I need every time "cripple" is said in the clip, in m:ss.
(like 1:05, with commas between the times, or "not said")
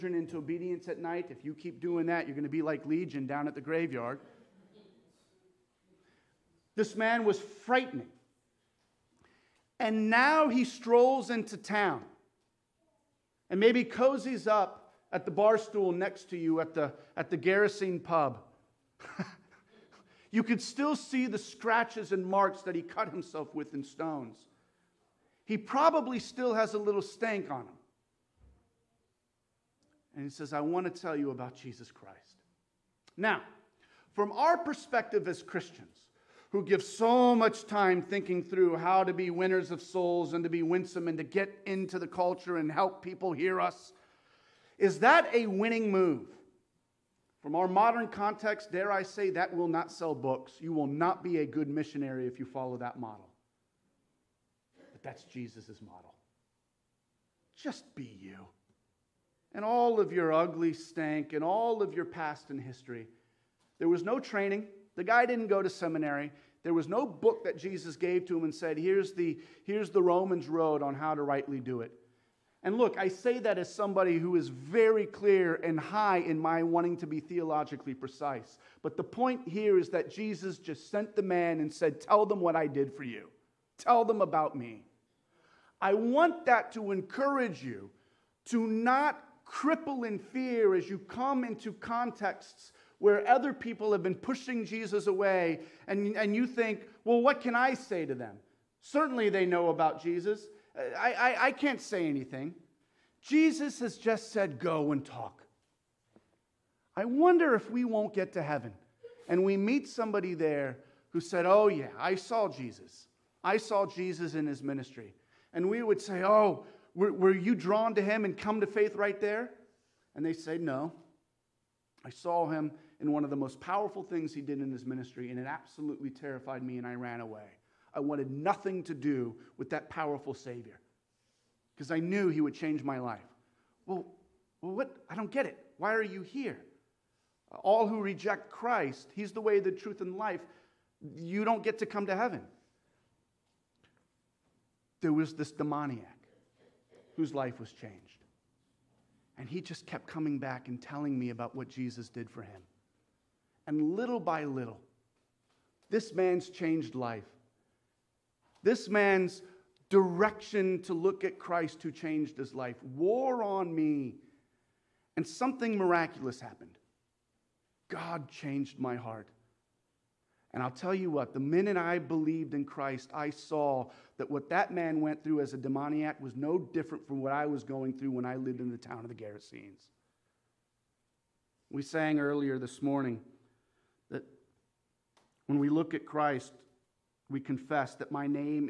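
1:29.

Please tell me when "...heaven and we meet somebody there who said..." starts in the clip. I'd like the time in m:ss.
1:48.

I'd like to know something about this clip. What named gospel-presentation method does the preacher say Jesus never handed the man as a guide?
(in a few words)
Romans road.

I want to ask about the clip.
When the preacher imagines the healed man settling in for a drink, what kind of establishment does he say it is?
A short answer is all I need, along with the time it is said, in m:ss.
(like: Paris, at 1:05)
Gerasene pub, at 0:17.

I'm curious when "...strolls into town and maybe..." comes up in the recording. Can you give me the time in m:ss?
0:10.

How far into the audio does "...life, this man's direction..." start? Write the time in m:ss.
2:36.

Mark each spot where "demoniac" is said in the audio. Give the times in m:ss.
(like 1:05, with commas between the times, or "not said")
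2:25, 2:55.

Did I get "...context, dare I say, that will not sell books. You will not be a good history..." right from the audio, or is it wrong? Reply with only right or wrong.
wrong.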